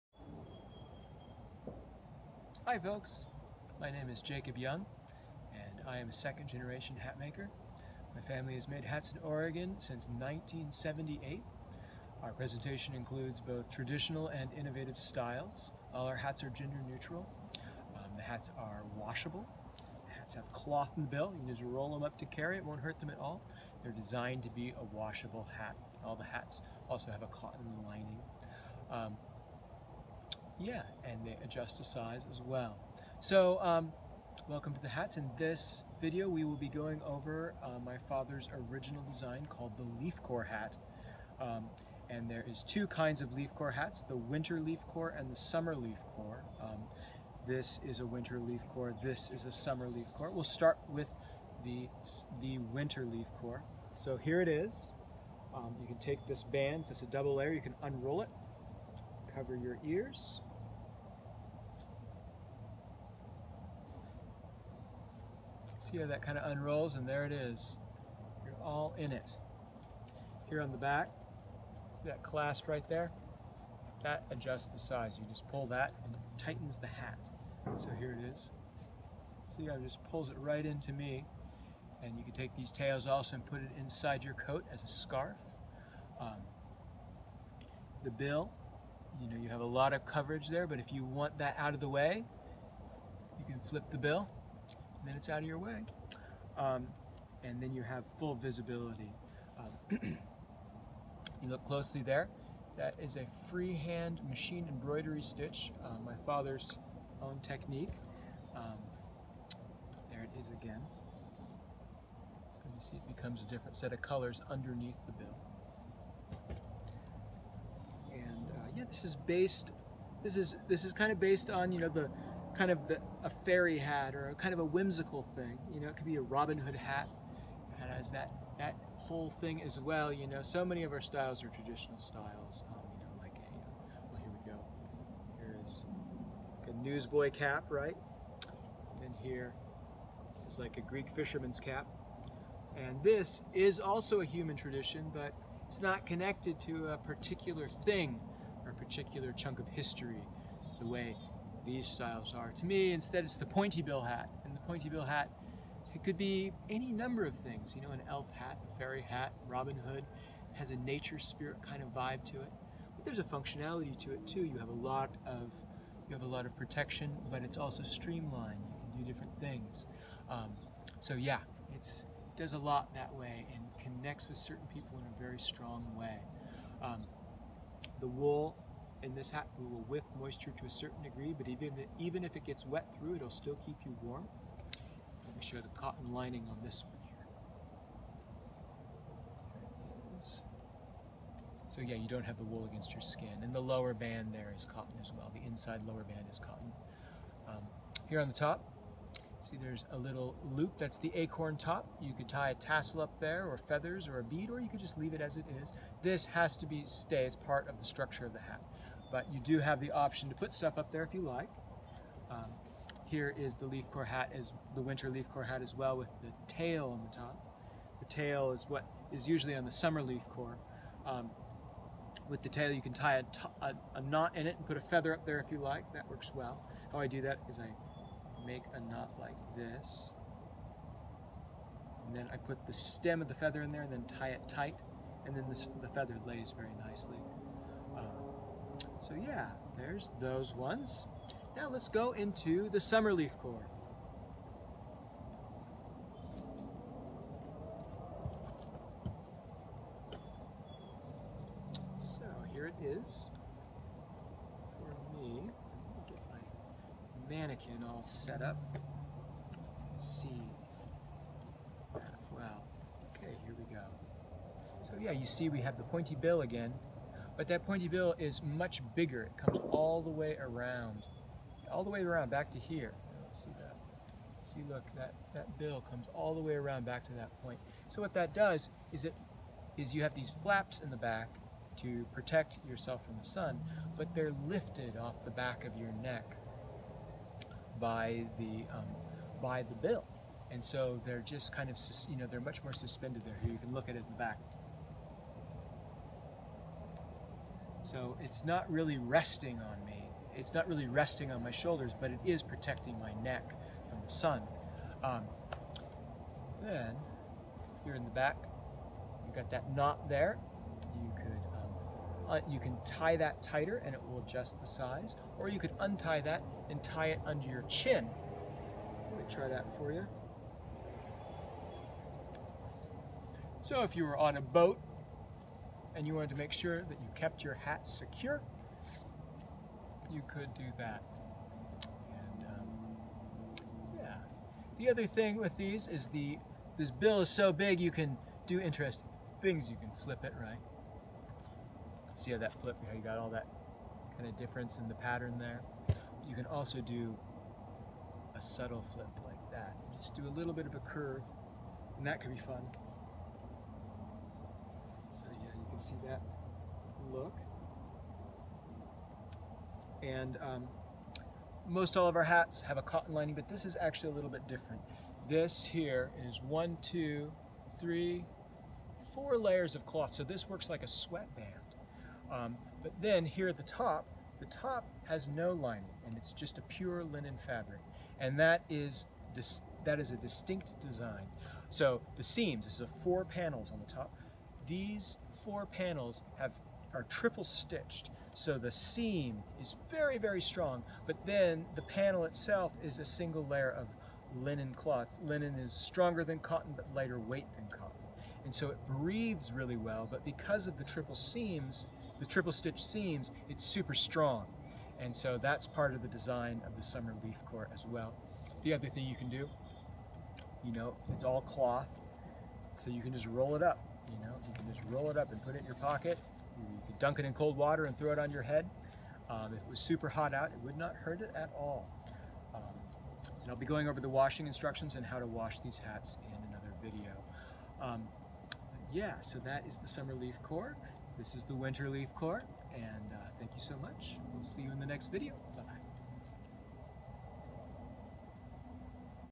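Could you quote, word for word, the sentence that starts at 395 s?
Linen is stronger than cotton, but lighter weight than cotton.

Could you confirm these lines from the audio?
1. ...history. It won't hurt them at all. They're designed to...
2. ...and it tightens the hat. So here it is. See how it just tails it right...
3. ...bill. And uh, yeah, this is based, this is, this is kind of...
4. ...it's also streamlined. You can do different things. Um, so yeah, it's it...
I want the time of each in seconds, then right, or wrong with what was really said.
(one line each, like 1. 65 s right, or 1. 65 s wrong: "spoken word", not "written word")
1. 22 s wrong: "carry", not "history"
2. 76 s wrong: "pulls", not "tails"
3. 115 s right
4. 167 s right.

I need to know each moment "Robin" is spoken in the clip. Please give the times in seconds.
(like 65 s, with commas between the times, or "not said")
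126 s, 159 s.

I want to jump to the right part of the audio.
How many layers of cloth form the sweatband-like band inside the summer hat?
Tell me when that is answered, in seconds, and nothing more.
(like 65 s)
369 s.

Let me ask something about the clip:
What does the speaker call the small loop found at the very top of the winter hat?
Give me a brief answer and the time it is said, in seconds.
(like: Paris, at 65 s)
the acorn top, at 201 s.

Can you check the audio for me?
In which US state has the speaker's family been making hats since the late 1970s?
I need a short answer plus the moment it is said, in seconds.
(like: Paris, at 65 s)
Oregon, at 9 s.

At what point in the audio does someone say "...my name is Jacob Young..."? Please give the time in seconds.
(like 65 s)
3 s.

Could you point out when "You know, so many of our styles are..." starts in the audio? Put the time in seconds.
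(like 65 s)
130 s.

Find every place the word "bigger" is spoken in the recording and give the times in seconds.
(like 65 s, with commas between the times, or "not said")
268 s.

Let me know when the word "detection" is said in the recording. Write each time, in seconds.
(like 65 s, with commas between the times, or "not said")
not said.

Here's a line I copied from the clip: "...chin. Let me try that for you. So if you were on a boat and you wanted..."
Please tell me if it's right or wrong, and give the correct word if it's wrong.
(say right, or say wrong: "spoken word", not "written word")
right.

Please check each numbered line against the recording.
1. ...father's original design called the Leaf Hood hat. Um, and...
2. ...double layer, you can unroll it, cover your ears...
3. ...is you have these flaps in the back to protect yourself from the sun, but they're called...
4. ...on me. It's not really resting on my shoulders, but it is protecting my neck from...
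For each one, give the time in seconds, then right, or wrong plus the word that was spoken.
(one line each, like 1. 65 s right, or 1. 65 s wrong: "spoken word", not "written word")
1. 38 s wrong: "Corps", not "Hood"
2. 57 s right
3. 279 s wrong: "lifted", not "called"
4. 299 s right.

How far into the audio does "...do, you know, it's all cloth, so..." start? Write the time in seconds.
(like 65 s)
409 s.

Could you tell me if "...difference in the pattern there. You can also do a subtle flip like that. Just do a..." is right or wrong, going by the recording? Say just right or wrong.
right.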